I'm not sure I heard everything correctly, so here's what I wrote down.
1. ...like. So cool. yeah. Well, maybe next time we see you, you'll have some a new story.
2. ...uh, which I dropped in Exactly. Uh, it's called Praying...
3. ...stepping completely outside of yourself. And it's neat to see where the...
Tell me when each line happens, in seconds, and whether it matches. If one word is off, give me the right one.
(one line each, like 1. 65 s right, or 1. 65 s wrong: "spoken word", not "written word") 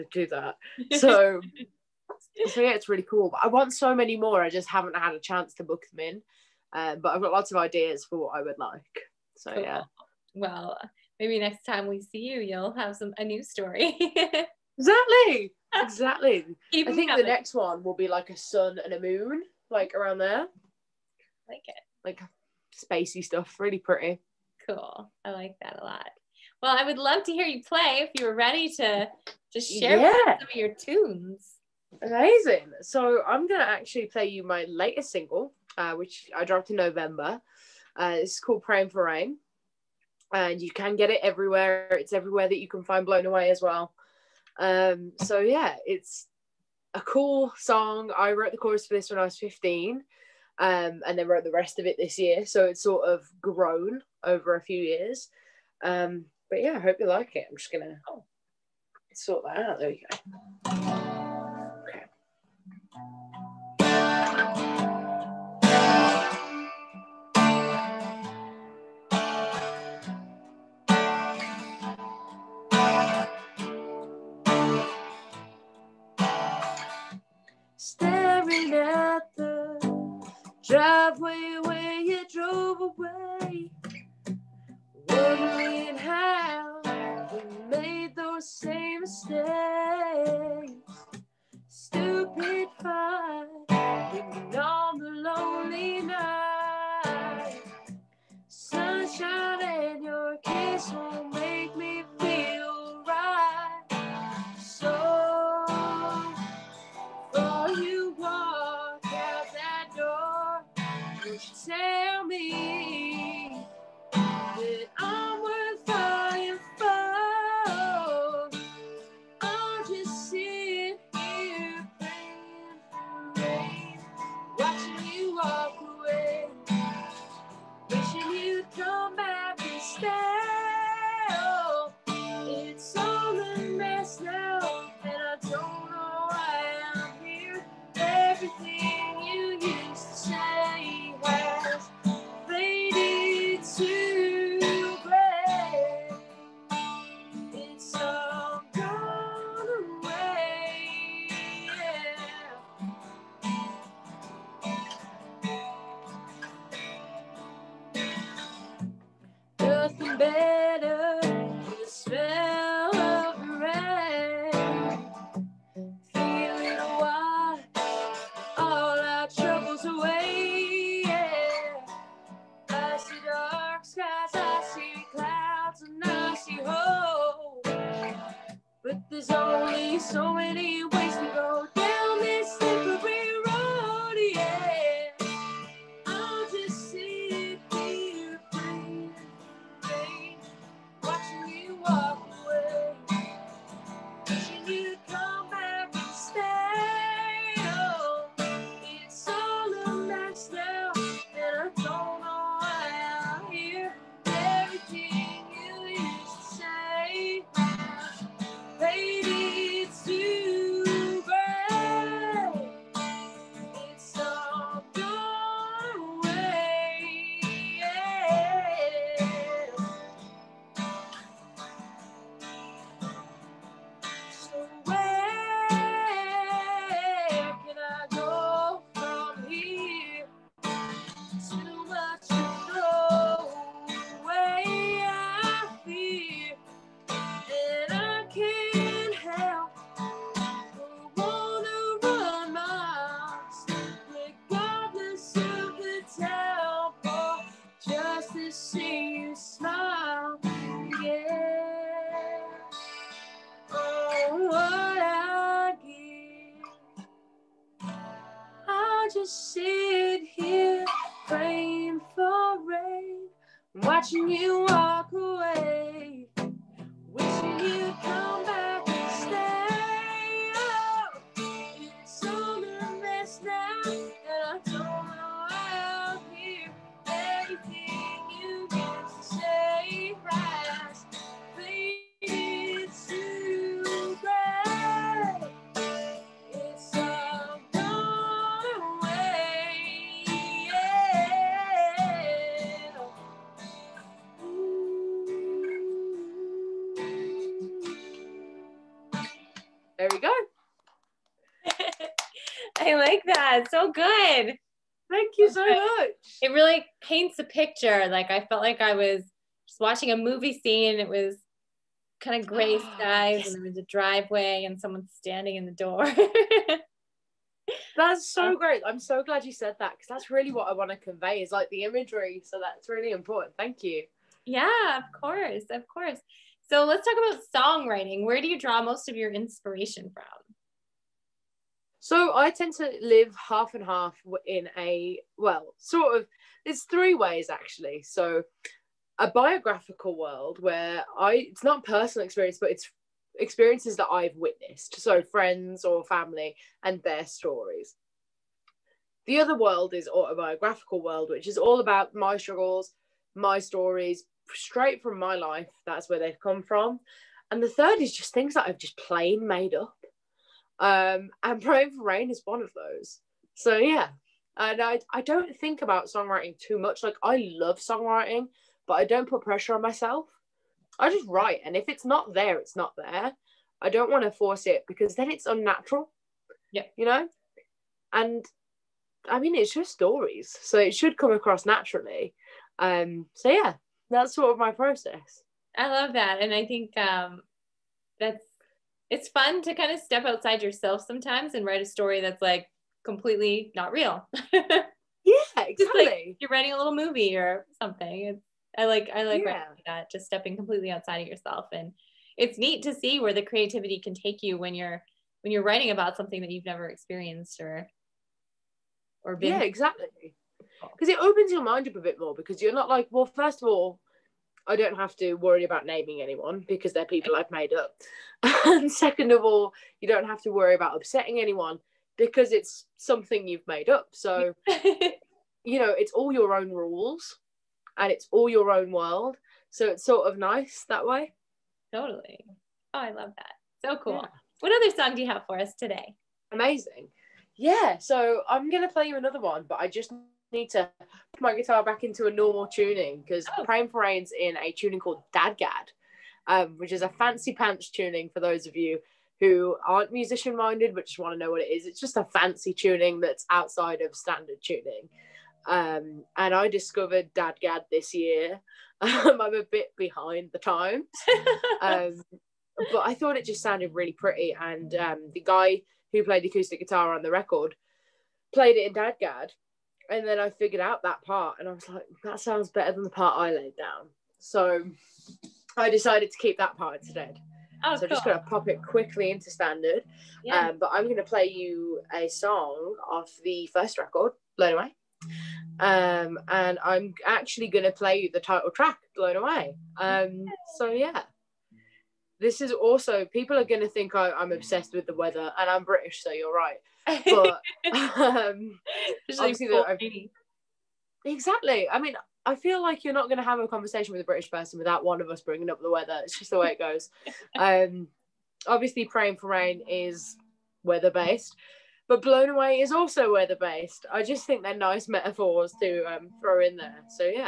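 1. 8 s right
2. 35 s wrong: "November", not "Exactly"
3. 400 s right.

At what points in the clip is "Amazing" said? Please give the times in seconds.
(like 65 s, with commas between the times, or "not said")
32 s, 436 s.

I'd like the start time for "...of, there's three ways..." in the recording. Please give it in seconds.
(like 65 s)
336 s.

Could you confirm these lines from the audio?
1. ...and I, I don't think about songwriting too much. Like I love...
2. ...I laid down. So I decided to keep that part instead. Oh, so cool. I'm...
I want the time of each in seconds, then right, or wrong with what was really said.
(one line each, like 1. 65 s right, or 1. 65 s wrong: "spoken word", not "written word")
1. 364 s right
2. 473 s right.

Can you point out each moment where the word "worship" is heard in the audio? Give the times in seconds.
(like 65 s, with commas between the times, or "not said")
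not said.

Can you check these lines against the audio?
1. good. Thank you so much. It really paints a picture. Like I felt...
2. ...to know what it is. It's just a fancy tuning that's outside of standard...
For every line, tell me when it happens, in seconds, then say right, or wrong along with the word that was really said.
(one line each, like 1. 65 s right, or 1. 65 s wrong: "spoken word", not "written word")
1. 303 s right
2. 451 s right.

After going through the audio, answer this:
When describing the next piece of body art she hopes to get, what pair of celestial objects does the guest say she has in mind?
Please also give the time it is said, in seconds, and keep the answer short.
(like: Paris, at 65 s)
A sun and a moon, at 18 s.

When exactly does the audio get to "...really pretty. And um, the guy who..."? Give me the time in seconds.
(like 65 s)
463 s.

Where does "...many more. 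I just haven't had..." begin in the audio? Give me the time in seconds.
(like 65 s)
3 s.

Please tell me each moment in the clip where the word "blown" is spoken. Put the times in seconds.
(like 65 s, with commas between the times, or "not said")
43 s, 484 s, 489 s, 512 s.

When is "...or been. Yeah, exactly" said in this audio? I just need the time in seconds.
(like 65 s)
409 s.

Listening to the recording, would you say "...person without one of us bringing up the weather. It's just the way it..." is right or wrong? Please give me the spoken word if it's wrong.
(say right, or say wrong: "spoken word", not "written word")
right.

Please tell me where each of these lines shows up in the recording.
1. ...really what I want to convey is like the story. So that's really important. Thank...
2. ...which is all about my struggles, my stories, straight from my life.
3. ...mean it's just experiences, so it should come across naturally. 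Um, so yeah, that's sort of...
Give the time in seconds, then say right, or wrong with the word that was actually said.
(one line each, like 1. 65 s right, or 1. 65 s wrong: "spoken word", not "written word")
1. 320 s wrong: "imagery", not "story"
2. 351 s right
3. 379 s wrong: "stories", not "experiences".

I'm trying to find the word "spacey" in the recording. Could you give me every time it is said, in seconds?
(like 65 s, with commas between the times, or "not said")
22 s.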